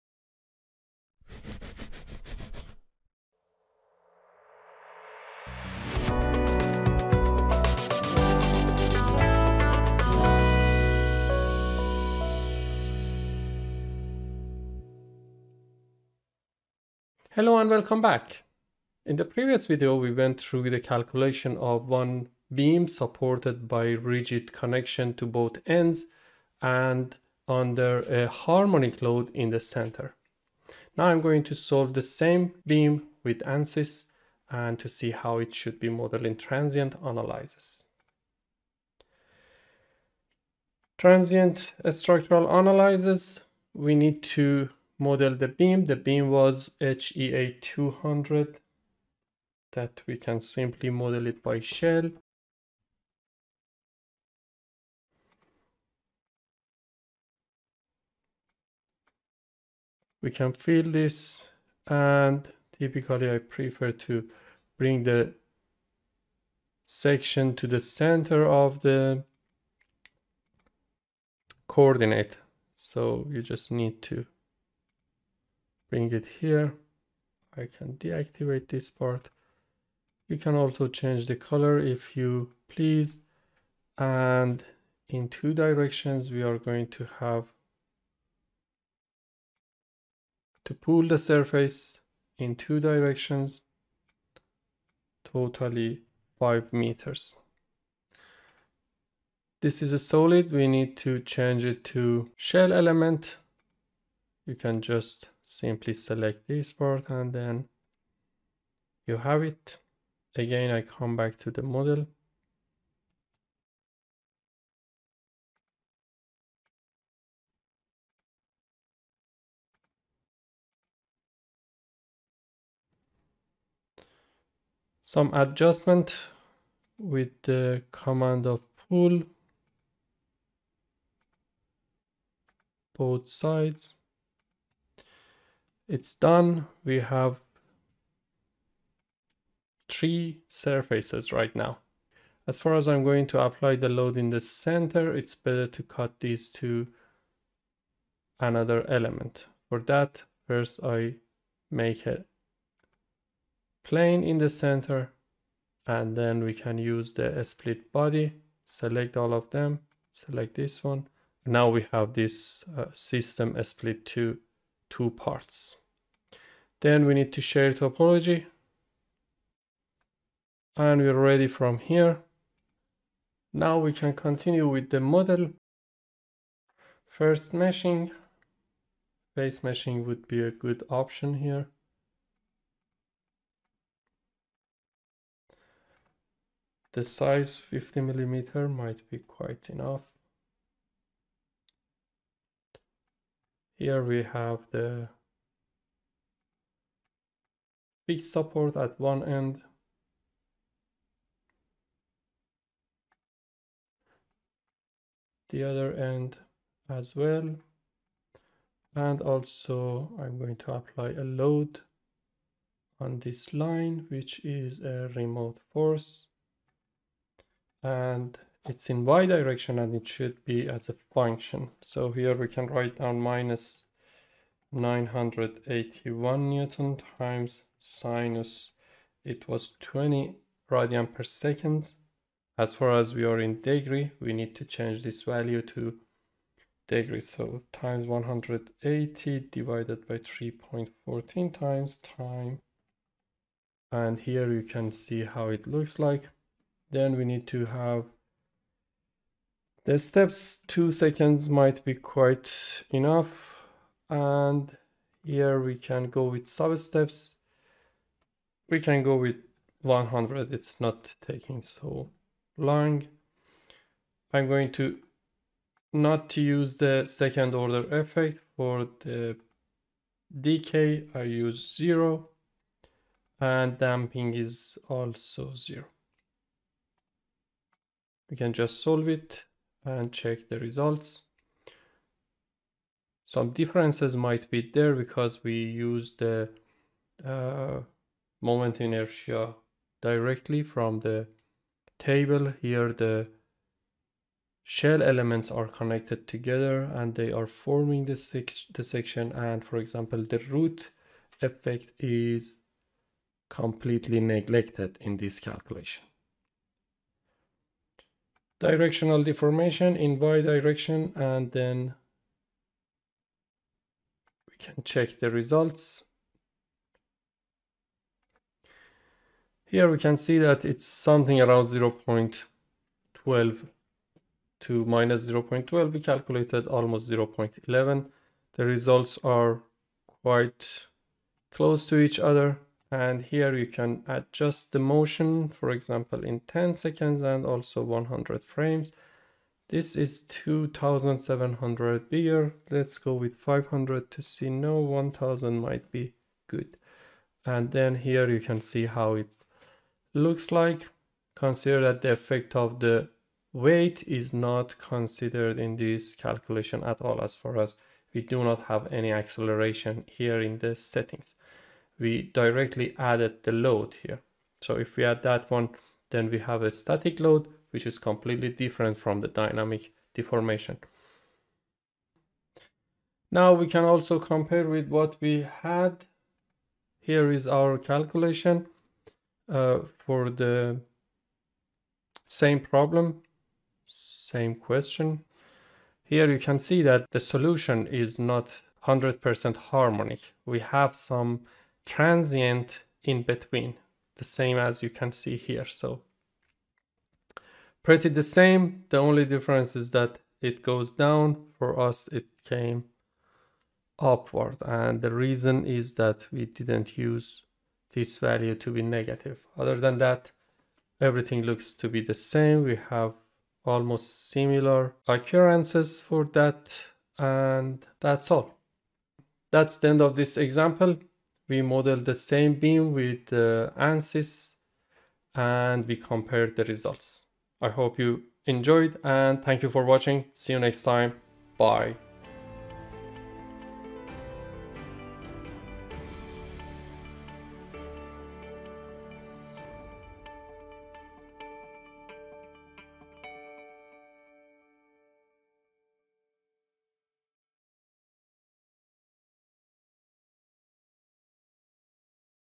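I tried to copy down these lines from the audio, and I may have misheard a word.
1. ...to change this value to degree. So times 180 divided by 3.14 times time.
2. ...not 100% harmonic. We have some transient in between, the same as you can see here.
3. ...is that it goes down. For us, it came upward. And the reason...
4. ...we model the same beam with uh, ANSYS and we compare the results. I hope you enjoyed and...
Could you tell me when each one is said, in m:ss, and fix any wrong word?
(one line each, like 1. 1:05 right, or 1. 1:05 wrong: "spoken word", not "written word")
1. 3:54 right
2. 6:28 right
3. 6:39 right
4. 7:01 right.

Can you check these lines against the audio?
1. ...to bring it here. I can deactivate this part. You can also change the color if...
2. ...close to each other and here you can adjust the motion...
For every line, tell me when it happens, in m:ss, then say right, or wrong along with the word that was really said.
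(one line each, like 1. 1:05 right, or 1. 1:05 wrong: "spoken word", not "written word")
1. 1:14 right
2. 5:31 right.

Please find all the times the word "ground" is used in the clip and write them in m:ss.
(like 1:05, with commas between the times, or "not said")
not said.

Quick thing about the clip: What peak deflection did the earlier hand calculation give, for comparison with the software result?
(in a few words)
0.11.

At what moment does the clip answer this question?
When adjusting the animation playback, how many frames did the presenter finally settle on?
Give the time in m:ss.
5:44.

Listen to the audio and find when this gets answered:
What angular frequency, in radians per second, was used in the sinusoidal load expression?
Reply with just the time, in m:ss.
3:49.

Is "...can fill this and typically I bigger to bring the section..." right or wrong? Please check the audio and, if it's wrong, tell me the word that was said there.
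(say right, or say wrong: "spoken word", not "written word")
wrong: "prefer", not "bigger".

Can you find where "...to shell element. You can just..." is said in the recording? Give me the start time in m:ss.
1:41.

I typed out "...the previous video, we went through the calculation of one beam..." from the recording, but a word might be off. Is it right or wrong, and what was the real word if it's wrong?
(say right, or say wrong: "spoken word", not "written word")
right.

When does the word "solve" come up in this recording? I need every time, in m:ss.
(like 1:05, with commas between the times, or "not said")
0:31, 4:38.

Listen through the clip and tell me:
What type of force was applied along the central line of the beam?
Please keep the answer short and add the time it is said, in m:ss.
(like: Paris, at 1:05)
remote force, at 3:35.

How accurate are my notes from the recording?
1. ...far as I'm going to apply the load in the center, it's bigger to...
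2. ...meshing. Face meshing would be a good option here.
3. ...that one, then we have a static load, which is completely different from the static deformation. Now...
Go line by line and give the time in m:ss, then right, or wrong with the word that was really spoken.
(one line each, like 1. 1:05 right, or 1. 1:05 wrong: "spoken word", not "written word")
1. 2:22 wrong: "better", not "bigger"
2. 2:57 right
3. 6:05 wrong: "dynamic", not "static".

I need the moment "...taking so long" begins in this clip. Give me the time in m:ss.
4:21.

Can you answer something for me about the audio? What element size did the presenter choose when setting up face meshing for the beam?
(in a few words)
50 millimeter.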